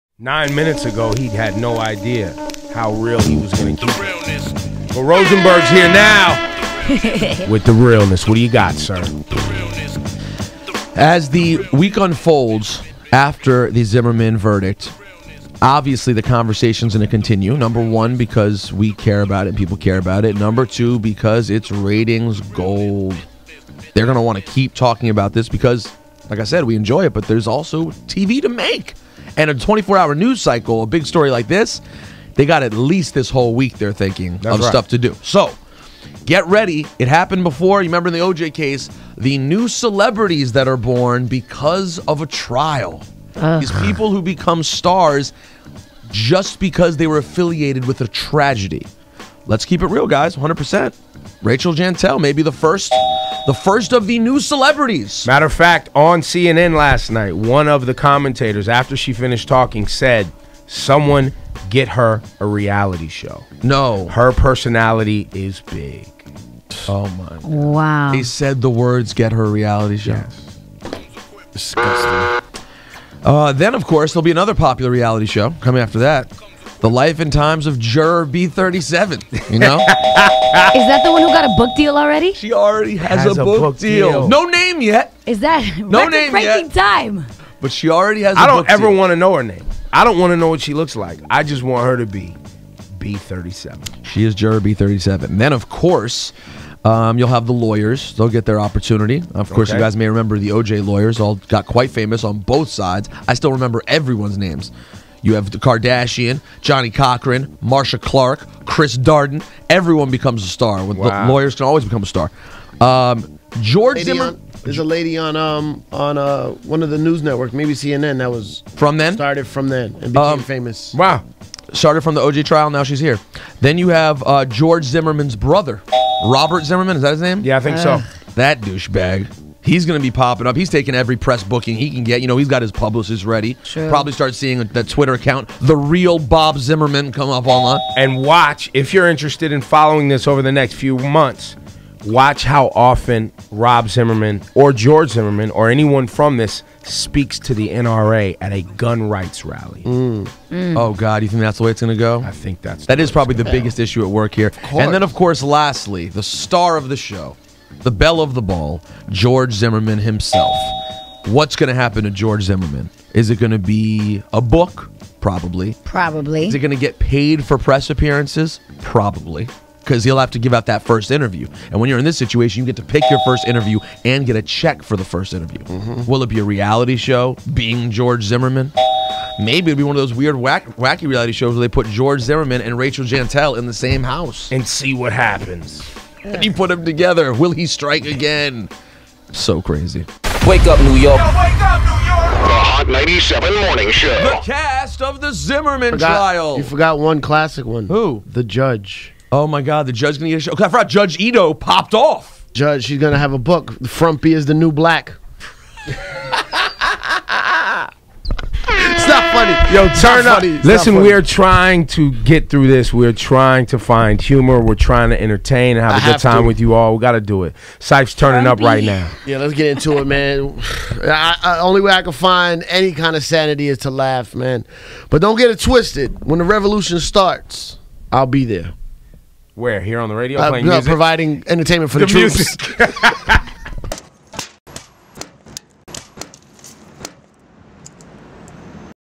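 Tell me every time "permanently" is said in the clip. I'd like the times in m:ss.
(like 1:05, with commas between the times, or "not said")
not said.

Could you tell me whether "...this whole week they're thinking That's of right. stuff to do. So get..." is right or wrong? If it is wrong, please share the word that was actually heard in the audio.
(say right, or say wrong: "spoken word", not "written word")
right.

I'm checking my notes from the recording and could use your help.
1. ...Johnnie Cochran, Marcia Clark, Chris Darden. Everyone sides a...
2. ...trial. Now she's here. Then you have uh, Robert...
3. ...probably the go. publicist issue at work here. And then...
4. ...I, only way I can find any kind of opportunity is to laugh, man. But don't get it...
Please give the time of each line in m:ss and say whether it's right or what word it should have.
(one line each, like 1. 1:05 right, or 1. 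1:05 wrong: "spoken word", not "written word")
1. 1:46 wrong: "becomes", not "sides"
2. 2:02 wrong: "George", not "Robert"
3. 2:33 wrong: "biggest", not "publicist"
4. 3:41 wrong: "sanity", not "opportunity".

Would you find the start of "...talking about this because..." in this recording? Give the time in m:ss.
0:24.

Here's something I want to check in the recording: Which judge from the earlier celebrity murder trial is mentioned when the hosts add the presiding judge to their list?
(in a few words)
Judge Ito.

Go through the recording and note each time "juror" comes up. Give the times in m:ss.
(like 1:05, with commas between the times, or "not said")
1:17, 1:34.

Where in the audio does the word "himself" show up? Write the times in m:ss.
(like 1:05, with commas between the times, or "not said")
2:39.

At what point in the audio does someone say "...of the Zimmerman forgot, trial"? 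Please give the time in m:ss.
3:15.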